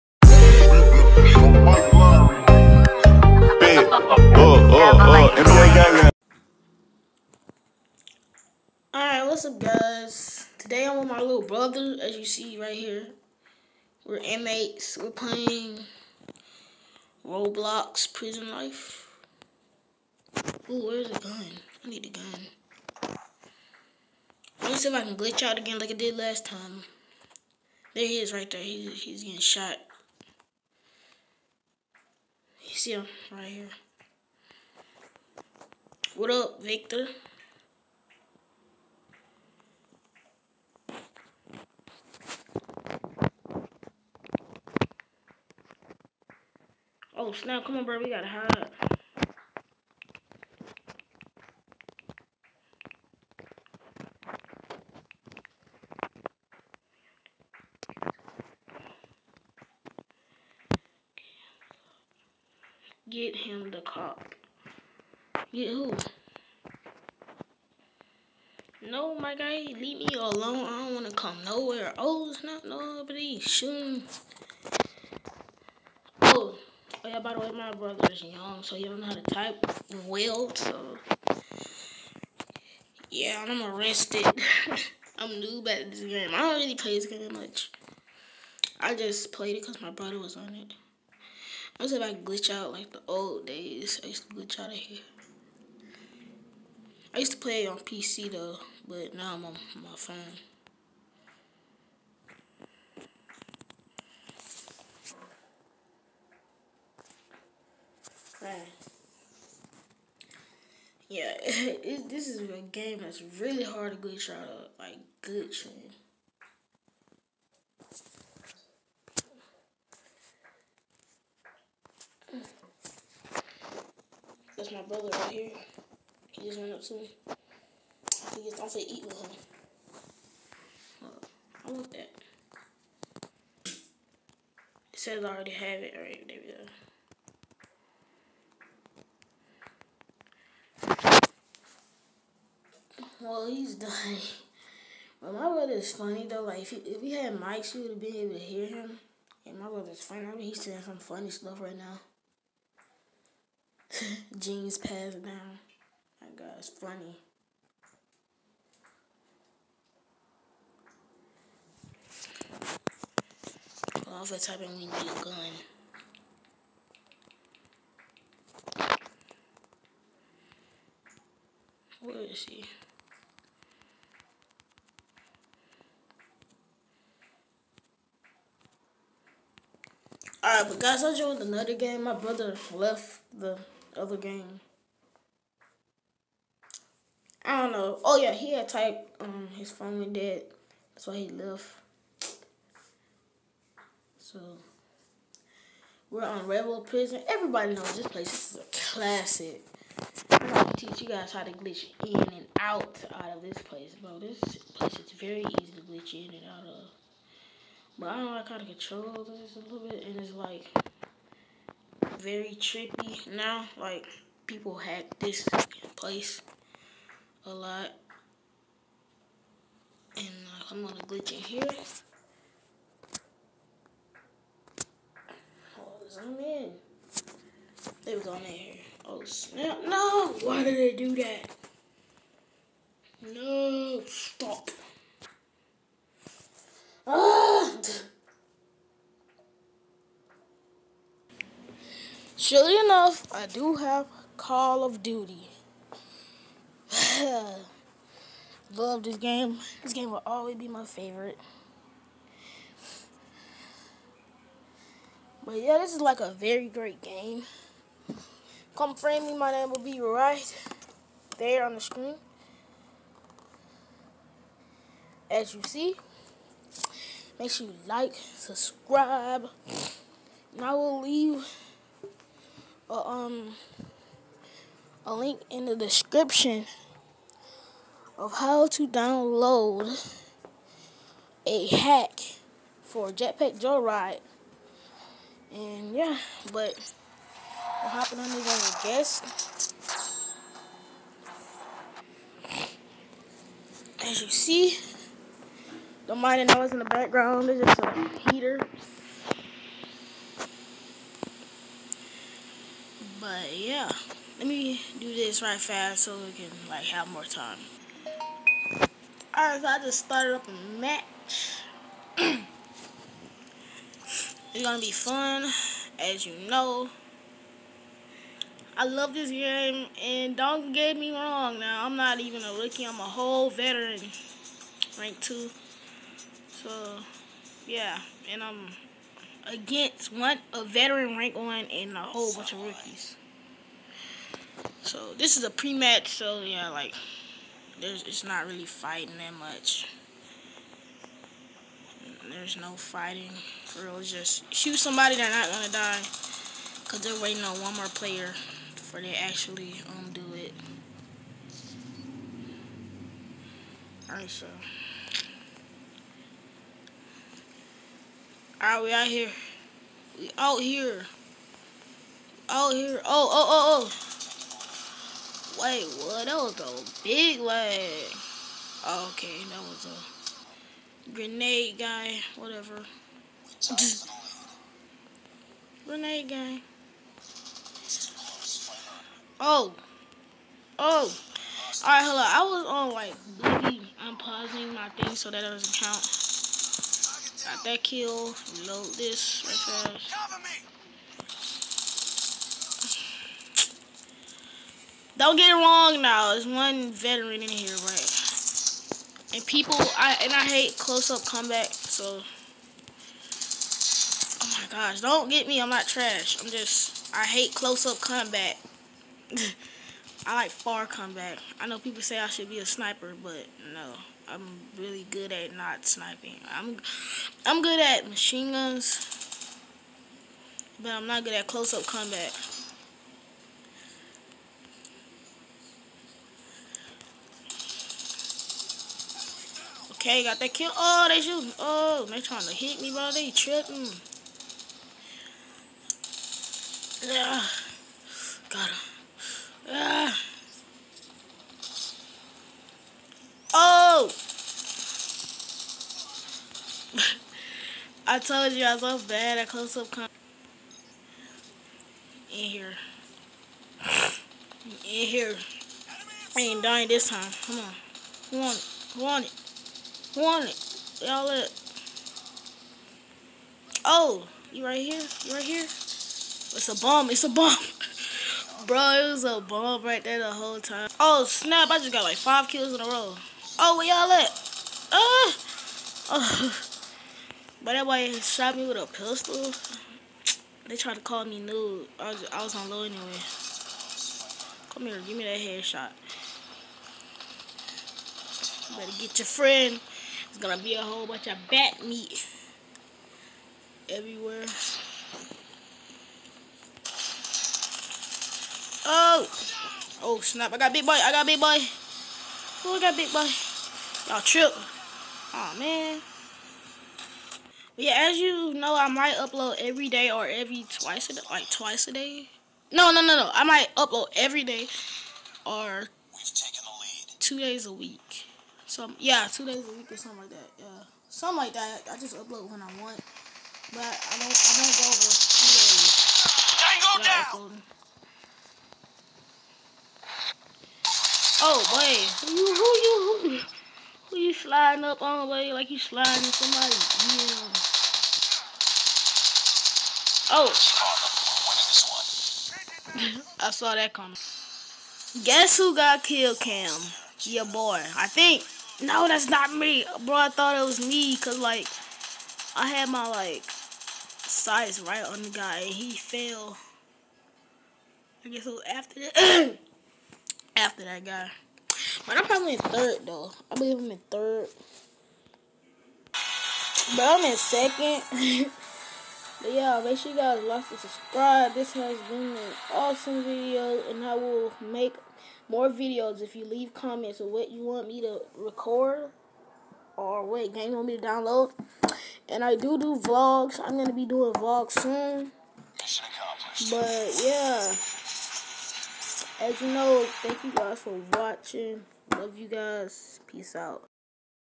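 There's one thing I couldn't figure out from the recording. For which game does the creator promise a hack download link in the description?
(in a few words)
Jetpack Joyride.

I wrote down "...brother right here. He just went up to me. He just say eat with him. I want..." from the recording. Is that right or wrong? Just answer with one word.
right.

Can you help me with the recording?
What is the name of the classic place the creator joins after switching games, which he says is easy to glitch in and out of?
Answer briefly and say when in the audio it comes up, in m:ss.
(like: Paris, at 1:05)
Rebel Prison, at 3:16.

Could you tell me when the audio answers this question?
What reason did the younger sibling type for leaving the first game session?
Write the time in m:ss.
3:09.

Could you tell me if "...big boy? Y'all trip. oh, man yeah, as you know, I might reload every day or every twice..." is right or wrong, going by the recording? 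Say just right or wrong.
wrong.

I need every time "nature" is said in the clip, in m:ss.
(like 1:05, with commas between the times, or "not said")
not said.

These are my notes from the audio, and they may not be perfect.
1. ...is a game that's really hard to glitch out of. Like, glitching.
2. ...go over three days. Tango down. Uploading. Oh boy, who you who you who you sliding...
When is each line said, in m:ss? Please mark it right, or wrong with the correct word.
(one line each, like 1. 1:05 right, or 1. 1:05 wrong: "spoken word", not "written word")
1. 1:52 right
2. 8:44 wrong: "two", not "three".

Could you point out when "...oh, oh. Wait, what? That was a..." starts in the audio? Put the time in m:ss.
6:03.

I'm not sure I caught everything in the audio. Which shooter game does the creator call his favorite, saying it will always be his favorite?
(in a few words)
Call of Duty.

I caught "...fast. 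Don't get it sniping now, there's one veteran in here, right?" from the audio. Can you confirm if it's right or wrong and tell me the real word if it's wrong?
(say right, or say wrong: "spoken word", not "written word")
wrong: "wrong", not "sniping".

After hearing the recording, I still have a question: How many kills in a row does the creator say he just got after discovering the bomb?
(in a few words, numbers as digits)
5.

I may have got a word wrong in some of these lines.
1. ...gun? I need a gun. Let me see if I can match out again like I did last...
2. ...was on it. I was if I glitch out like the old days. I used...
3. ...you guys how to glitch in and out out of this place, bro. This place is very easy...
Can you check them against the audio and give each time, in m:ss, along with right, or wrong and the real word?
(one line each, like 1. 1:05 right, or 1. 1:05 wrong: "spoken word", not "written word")
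1. 0:21 wrong: "glitch", not "match"
2. 1:30 right
3. 3:21 right.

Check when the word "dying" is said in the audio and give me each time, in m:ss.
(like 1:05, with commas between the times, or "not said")
2:23, 7:36.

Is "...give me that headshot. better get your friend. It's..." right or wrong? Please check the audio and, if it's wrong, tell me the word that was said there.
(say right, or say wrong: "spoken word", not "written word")
right.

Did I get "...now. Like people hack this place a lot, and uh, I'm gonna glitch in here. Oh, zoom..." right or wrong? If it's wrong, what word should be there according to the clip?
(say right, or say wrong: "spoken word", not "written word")
right.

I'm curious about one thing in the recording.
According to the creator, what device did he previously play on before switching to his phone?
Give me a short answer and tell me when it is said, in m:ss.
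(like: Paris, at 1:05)
PC, at 1:37.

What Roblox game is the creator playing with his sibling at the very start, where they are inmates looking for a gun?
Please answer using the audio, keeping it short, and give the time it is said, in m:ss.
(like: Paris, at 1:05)
Prison Life, at 0:18.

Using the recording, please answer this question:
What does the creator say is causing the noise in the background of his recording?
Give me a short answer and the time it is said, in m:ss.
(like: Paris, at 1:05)
a heater, at 4:57.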